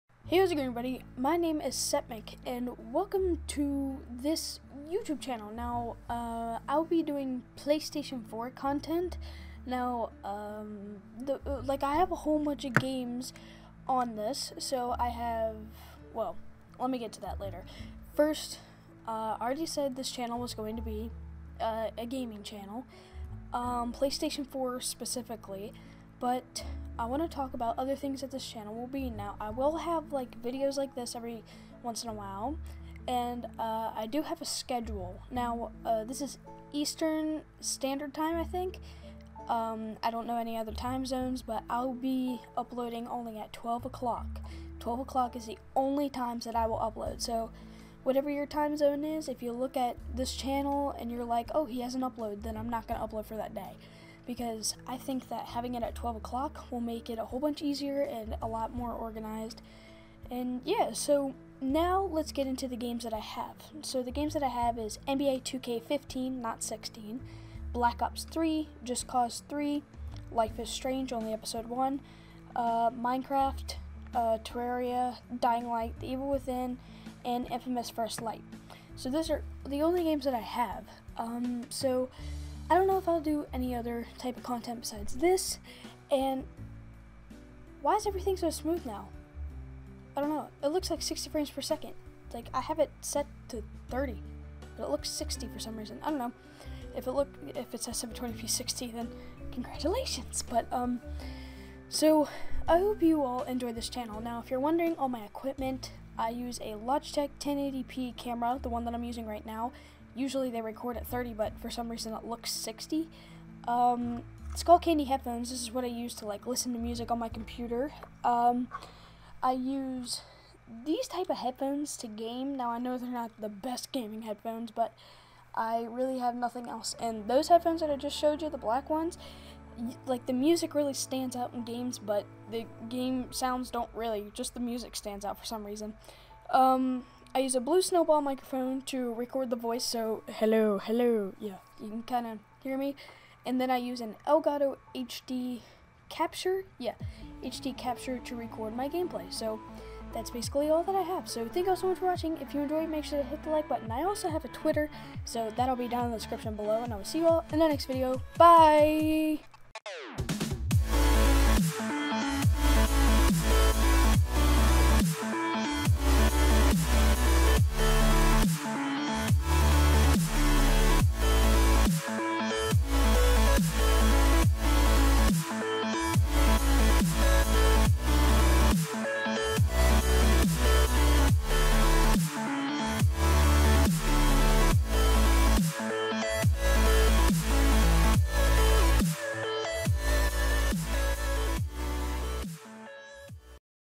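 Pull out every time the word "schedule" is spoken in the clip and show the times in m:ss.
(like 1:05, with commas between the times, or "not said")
0:34.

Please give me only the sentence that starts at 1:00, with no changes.
And yeah, so now let's get into the games that I have.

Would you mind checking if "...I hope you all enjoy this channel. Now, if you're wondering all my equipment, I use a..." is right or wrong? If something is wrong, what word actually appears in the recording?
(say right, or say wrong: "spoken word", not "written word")
right.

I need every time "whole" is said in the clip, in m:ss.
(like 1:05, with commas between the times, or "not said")
0:12, 0:57.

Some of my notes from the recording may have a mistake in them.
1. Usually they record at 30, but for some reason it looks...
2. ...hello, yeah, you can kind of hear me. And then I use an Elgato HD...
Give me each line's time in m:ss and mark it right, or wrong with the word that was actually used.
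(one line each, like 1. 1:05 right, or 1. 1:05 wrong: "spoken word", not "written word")
1. 1:50 right
2. 2:20 right.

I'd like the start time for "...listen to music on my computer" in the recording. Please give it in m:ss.
1:56.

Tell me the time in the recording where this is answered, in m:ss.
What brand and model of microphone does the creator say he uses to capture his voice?
2:17.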